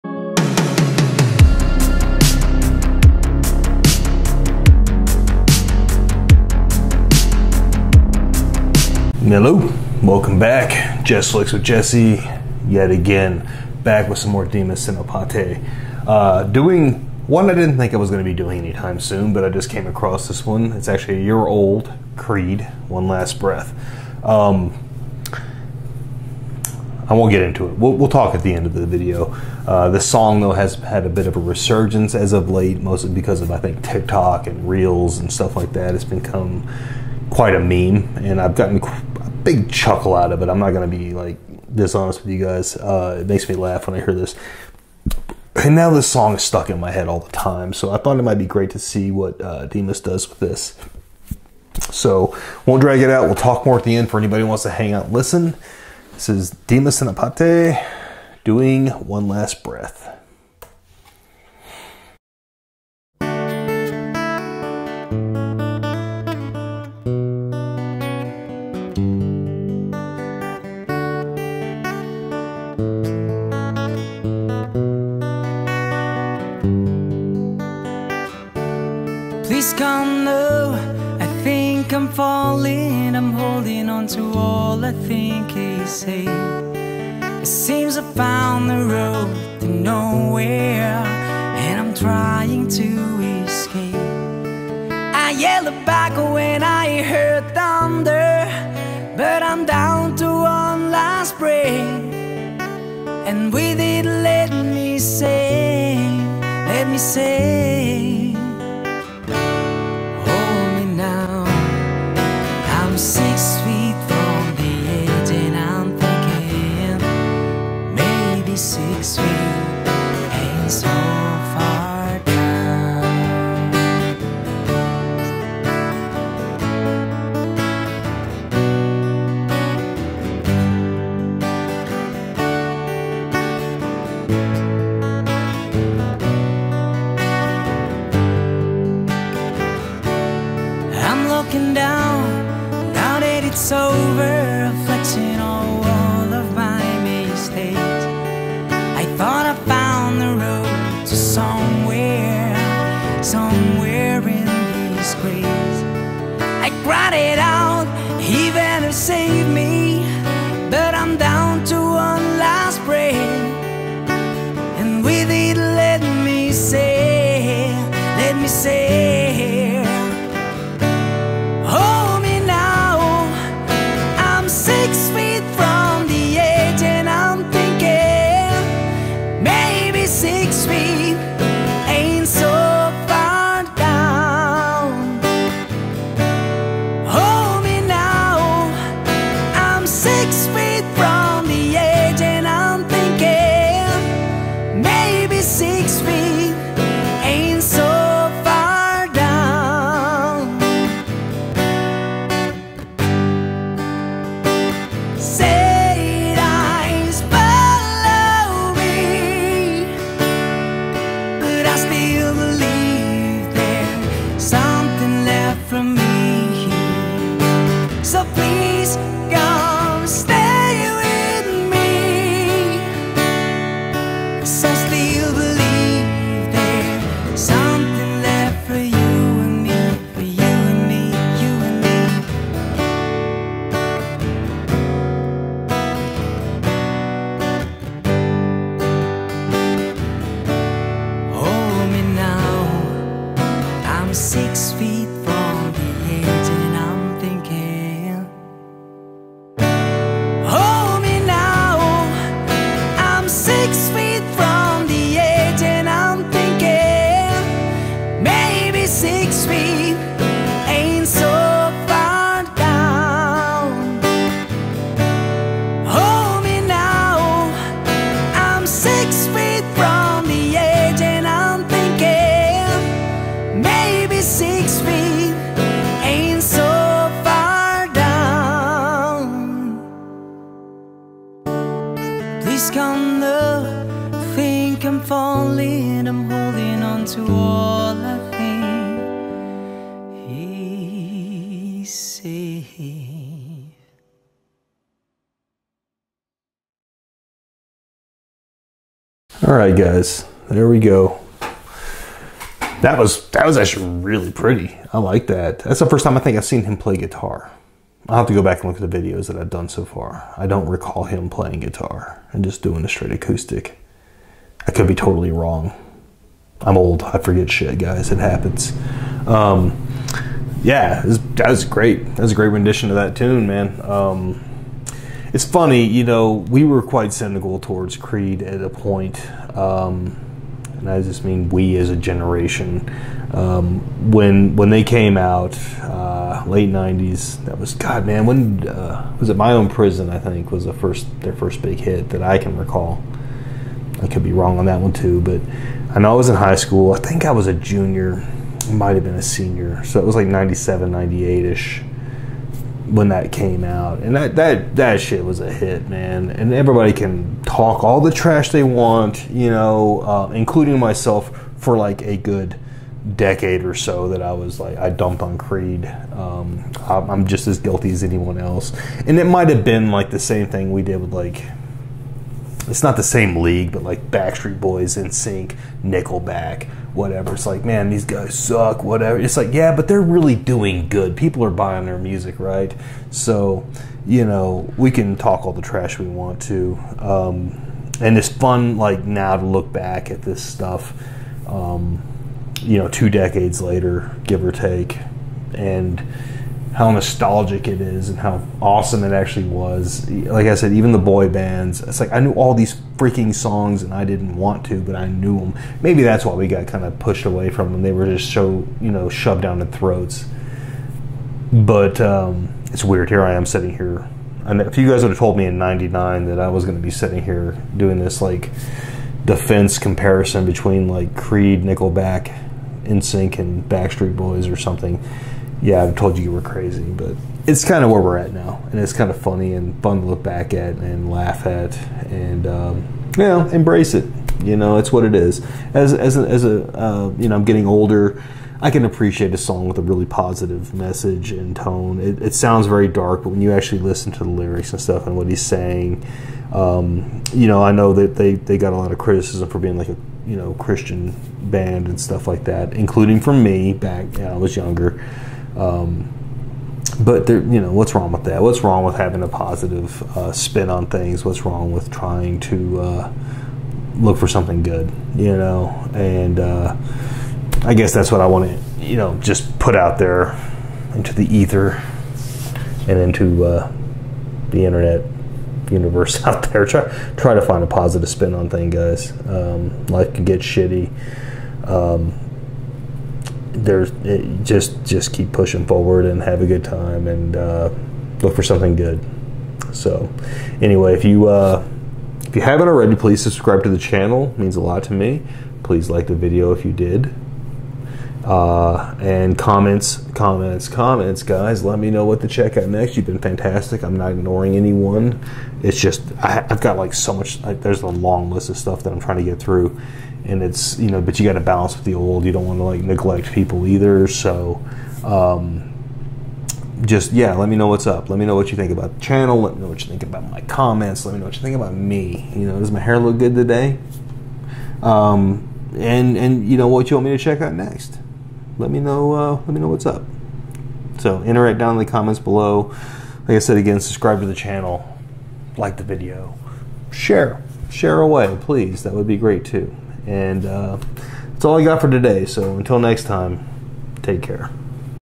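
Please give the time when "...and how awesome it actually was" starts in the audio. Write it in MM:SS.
06:38.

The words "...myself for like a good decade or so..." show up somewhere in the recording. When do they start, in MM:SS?
06:00.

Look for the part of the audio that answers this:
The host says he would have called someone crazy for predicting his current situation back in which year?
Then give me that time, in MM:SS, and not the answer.
06:55.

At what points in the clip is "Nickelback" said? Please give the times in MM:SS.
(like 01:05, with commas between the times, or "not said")
06:15, 07:01.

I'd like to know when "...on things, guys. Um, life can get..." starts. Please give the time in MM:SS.
07:58.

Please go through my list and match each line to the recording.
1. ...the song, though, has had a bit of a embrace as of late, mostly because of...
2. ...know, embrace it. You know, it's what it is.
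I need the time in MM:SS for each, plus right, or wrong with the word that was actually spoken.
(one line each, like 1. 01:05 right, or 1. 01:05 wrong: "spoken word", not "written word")
1. 00:29 wrong: "resurgence", not "embrace"
2. 07:13 right.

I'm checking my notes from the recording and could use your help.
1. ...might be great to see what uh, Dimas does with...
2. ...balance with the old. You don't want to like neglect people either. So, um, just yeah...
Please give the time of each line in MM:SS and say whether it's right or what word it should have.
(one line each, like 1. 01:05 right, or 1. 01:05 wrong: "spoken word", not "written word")
1. 00:48 right
2. 08:31 right.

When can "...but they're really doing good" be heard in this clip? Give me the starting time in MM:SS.
06:19.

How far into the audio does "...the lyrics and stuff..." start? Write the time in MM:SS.
07:24.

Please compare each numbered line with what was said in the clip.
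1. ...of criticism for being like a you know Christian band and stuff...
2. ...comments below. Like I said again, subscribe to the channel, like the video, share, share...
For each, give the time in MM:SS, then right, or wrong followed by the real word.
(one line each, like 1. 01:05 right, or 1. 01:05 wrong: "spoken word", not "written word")
1. 07:28 right
2. 08:51 right.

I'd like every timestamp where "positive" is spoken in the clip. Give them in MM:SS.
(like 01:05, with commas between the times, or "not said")
07:20, 07:39, 07:57.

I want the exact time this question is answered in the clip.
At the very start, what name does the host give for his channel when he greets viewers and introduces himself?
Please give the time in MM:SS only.
00:11.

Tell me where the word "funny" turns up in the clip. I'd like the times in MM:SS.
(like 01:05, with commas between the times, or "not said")
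05:25, 07:09.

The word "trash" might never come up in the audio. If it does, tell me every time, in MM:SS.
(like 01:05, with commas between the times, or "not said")
05:58, 06:25.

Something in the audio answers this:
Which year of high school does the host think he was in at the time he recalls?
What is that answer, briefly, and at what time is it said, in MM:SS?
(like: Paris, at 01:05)
junior, at 05:47.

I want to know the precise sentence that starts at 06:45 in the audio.
Maybe that's why we got kind of pushed away from them.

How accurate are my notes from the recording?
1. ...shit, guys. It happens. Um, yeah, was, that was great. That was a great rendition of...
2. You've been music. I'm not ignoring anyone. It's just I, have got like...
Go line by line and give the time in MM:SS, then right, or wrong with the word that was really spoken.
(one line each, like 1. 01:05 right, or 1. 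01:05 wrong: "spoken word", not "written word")
1. 05:17 right
2. 08:22 wrong: "fantastic", not "music".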